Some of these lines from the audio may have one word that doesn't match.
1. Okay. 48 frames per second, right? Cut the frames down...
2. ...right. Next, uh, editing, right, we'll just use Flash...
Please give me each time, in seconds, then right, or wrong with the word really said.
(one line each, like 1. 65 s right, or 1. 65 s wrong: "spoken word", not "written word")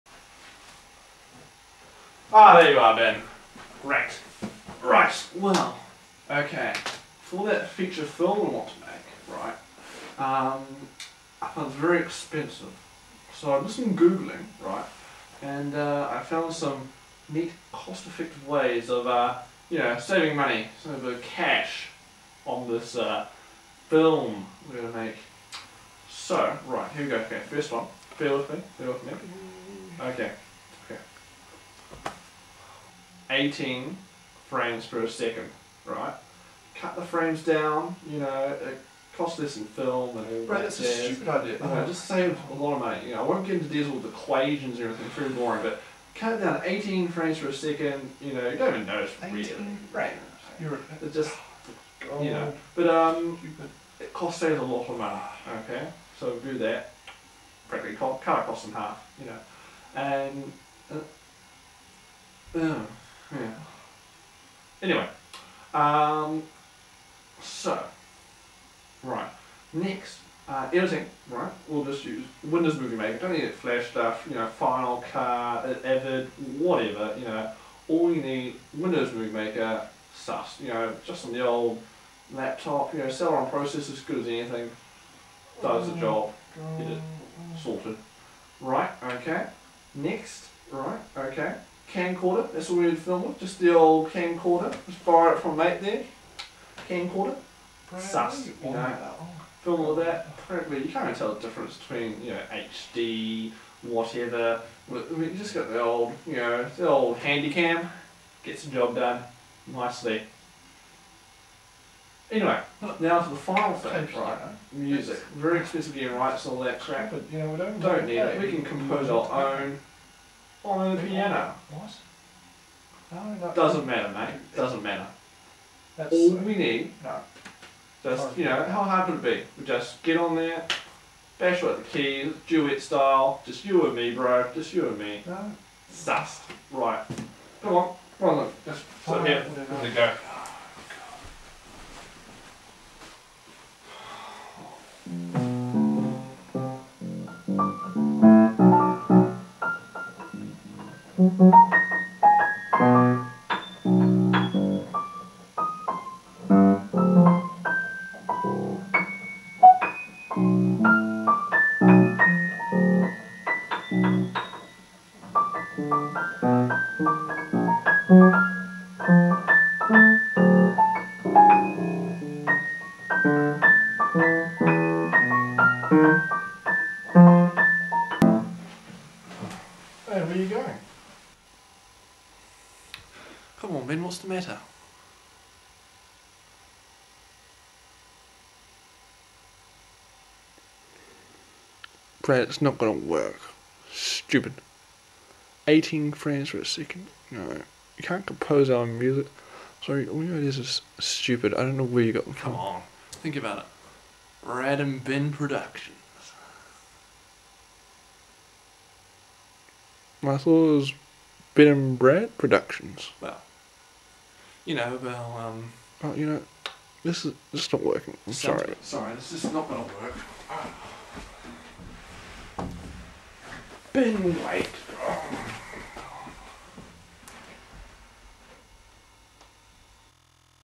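1. 29 s wrong: "18", not "48"
2. 69 s wrong: "Windows", not "Flash".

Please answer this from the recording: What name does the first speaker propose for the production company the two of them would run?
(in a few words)
Brad and Ben Productions.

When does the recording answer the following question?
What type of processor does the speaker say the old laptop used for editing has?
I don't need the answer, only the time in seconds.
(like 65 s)
83 s.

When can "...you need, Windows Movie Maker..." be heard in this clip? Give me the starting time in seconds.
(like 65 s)
78 s.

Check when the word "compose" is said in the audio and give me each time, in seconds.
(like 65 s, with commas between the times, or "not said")
118 s, 198 s.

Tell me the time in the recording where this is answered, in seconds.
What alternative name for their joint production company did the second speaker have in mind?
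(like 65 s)
211 s.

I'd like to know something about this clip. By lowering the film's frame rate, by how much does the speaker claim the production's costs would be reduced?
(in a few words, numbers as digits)
in half.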